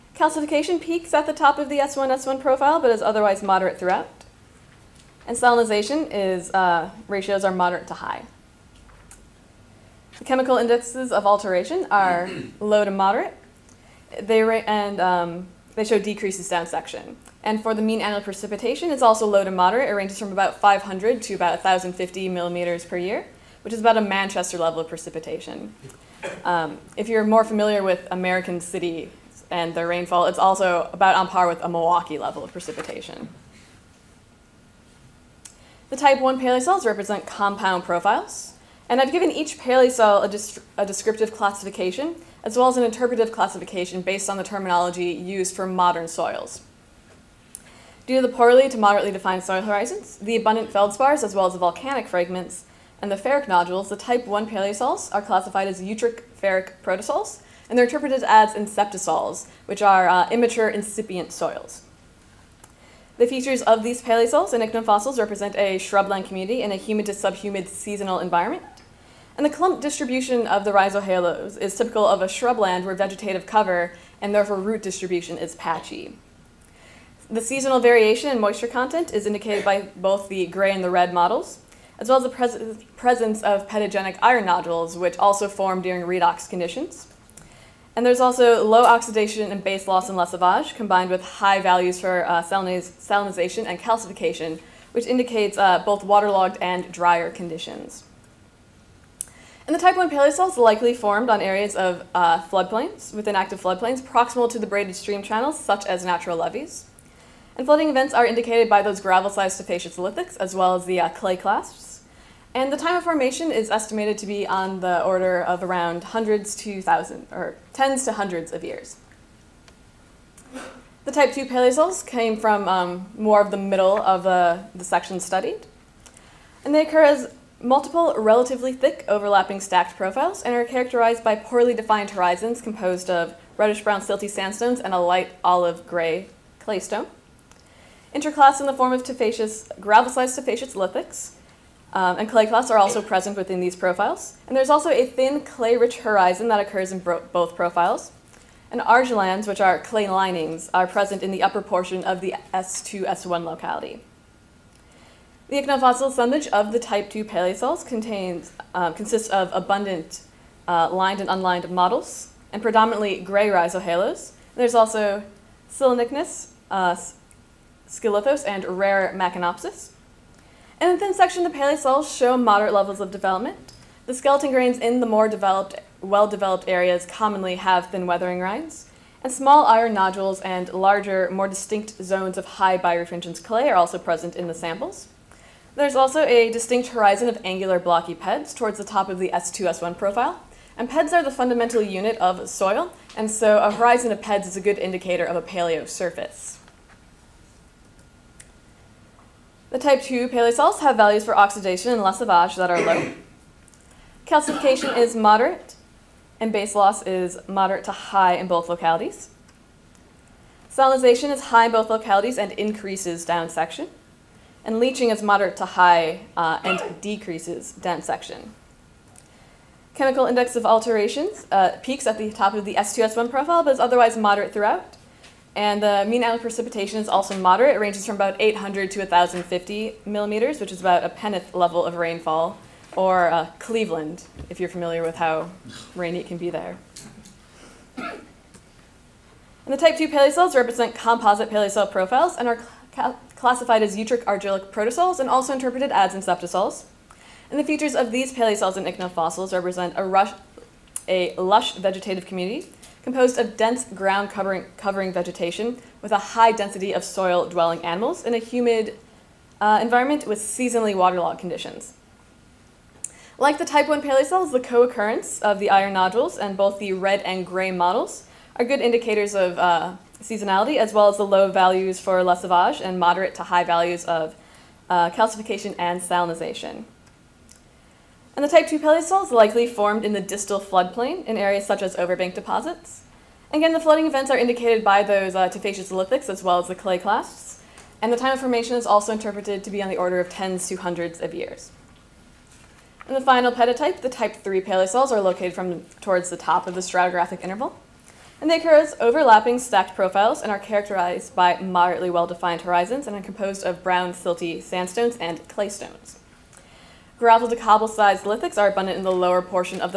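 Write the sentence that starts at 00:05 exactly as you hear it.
And salinization is, uh, ratios are moderate to high.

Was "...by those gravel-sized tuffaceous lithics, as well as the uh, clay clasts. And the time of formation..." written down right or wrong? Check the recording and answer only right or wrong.
right.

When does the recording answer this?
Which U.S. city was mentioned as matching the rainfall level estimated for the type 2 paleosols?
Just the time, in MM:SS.
03:53.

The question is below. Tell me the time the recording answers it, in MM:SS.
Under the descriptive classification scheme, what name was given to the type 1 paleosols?
00:55.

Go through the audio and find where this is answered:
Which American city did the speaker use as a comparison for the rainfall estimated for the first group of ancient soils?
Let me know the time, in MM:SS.
00:31.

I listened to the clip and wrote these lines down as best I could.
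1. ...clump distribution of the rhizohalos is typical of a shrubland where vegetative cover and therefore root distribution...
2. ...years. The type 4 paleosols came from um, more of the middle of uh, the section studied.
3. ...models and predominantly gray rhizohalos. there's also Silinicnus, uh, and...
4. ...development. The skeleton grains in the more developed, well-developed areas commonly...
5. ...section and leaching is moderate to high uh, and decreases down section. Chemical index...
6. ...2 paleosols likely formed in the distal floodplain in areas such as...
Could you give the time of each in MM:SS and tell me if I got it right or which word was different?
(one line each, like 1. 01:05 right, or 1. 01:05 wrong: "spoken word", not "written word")
1. 01:09 right
2. 01:58 wrong: "2", not "4"
3. 02:41 right
4. 02:53 right
5. 03:33 right
6. 04:38 right.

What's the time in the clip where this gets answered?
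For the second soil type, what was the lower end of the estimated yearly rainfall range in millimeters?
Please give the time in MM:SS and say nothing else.
03:48.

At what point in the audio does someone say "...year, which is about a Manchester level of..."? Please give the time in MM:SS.
00:22.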